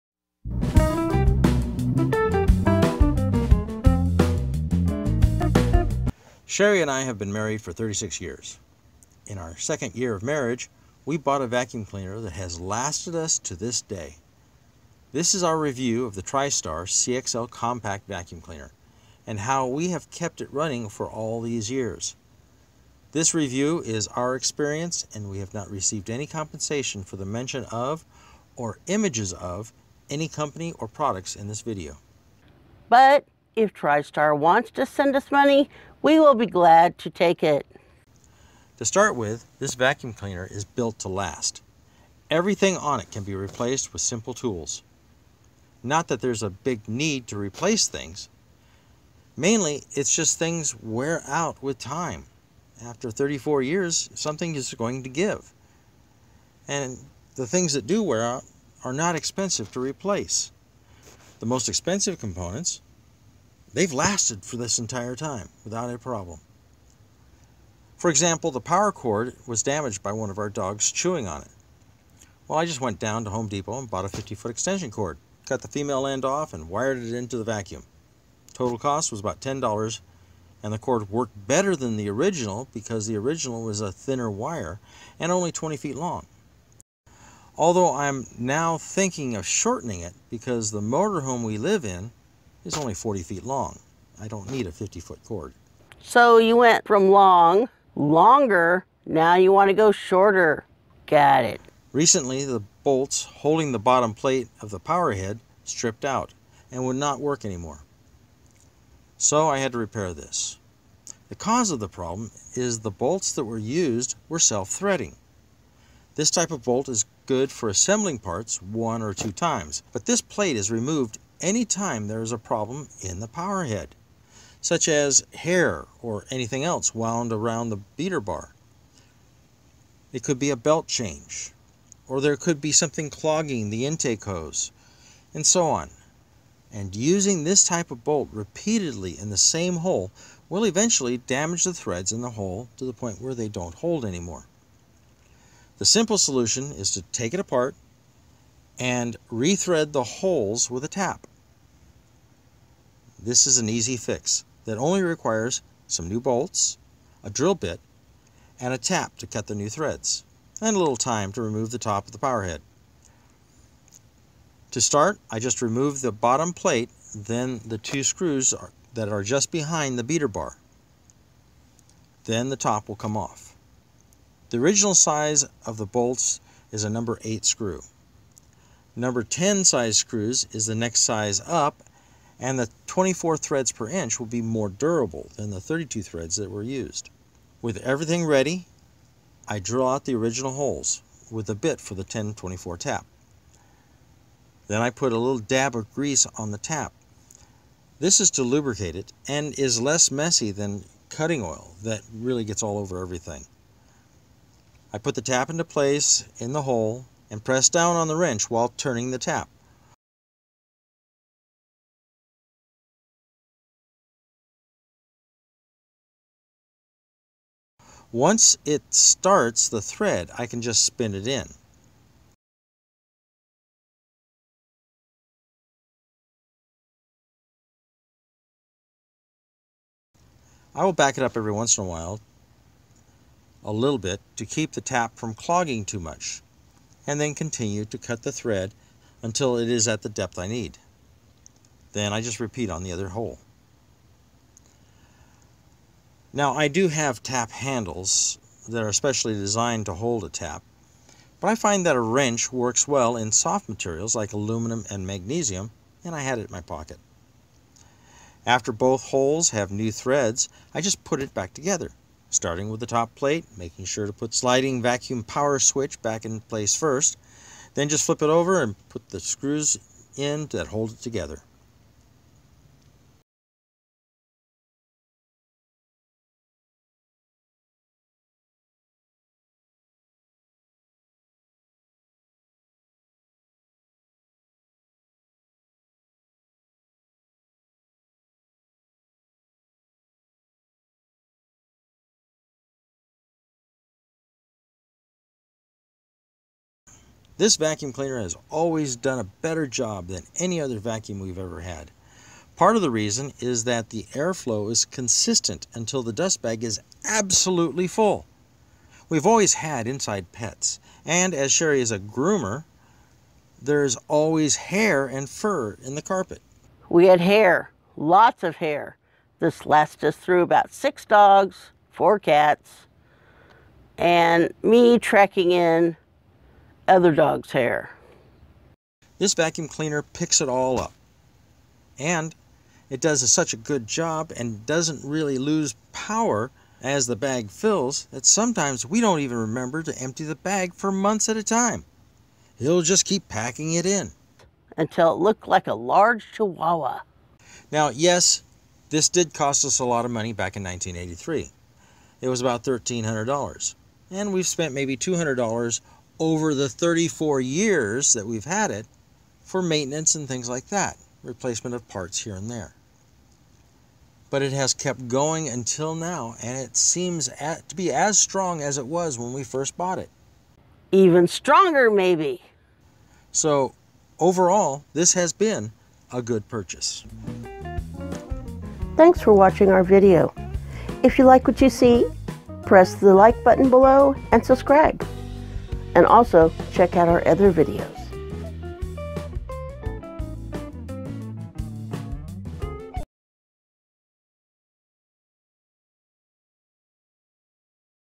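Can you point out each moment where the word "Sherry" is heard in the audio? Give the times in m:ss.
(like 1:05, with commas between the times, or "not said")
0:06, 5:11.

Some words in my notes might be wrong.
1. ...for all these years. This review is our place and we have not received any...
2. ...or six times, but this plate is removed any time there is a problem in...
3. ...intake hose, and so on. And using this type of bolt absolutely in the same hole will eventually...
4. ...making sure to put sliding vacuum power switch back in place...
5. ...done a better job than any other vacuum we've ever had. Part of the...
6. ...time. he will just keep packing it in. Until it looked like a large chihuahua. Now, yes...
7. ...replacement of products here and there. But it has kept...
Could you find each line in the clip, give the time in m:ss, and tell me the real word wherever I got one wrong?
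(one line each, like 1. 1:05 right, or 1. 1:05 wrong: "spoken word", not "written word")
1. 0:20 wrong: "experience", not "place"
2. 1:59 wrong: "two", not "six"
3. 2:13 wrong: "repeatedly", not "absolutely"
4. 4:23 right
5. 4:58 right
6. 5:41 right
7. 6:01 wrong: "parts", not "products".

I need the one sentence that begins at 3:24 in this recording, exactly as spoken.
I put the tap into place in the hole and press down on the wrench while turning the tap.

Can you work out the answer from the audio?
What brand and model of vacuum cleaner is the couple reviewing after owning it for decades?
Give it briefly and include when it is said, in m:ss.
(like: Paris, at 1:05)
TriStar CXL, at 0:16.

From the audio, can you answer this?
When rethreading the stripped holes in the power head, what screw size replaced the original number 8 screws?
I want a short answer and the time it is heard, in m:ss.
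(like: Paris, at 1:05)
Number 10, at 2:58.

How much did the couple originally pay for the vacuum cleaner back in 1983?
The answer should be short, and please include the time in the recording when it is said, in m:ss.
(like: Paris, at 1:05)
$1,300, at 5:52.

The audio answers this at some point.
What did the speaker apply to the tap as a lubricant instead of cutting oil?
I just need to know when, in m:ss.
3:15.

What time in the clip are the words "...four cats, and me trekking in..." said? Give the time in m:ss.
5:21.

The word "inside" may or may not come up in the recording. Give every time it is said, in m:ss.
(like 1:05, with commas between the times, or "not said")
5:09.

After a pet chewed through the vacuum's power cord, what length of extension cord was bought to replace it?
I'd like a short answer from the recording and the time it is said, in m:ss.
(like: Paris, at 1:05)
50-foot, at 1:14.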